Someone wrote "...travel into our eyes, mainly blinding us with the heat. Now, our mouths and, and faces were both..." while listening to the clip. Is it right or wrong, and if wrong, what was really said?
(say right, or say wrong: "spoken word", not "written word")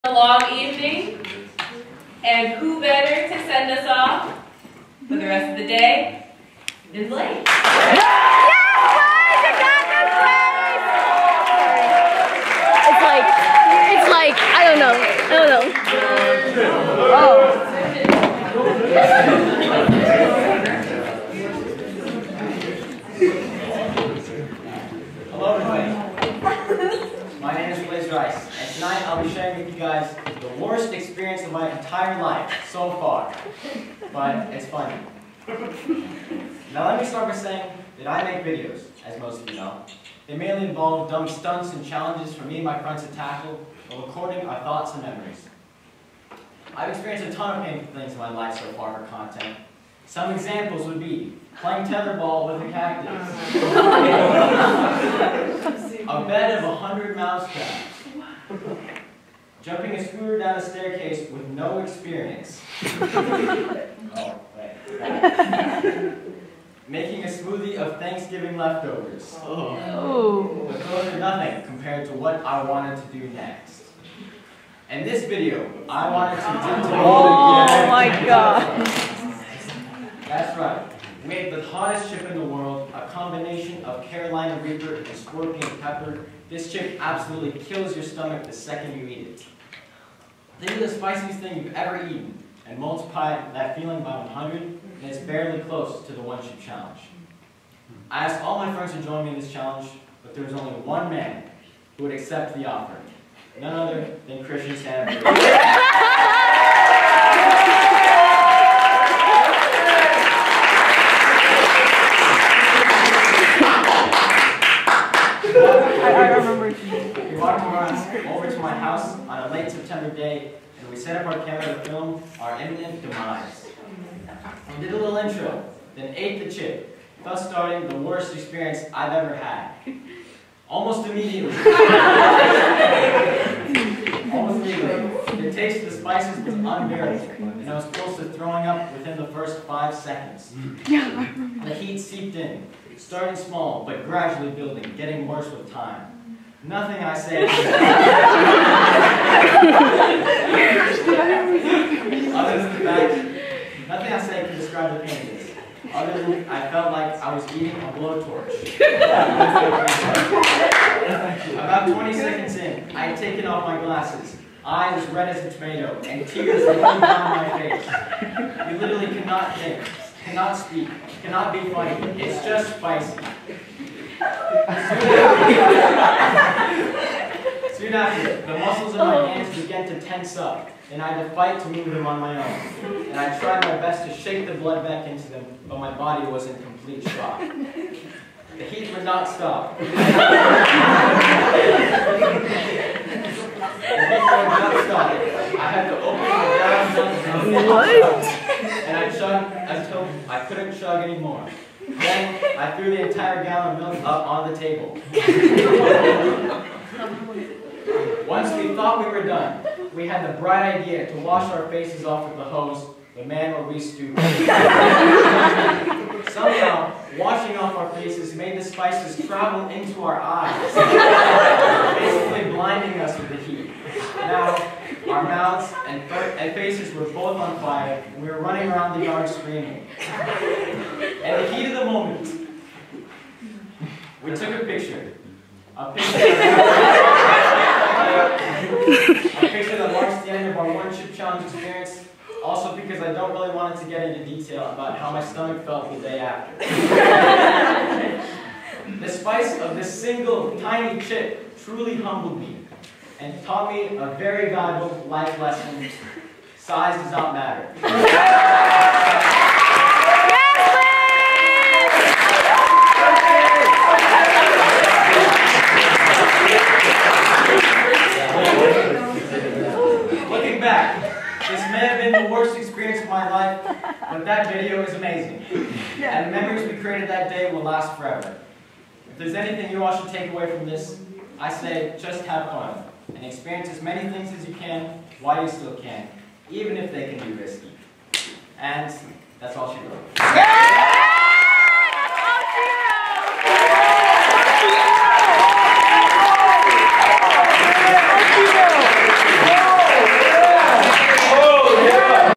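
wrong: "basically", not "mainly".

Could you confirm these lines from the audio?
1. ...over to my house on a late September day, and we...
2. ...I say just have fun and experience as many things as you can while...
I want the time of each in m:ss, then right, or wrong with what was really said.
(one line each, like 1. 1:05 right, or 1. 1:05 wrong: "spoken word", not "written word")
1. 1:58 right
2. 4:41 right.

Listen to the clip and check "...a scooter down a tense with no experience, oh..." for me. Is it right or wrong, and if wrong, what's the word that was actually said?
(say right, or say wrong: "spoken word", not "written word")
wrong: "staircase", not "tense".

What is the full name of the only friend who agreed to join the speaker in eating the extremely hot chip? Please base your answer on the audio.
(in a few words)
Christian Sandberg.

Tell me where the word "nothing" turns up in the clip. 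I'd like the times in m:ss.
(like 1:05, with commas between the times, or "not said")
1:11, 2:26, 2:33.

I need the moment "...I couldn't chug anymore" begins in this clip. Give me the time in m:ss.
3:20.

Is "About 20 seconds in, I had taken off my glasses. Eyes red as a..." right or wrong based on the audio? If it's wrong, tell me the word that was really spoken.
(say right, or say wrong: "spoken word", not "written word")
right.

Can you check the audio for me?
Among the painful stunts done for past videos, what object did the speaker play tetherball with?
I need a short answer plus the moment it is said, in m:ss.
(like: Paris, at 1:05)
a cactus, at 0:52.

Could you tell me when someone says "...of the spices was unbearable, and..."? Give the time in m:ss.
2:15.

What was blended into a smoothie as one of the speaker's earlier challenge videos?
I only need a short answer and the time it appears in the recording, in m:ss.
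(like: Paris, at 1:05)
Thanksgiving leftovers, at 1:07.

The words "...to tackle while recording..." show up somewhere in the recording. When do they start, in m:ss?
0:43.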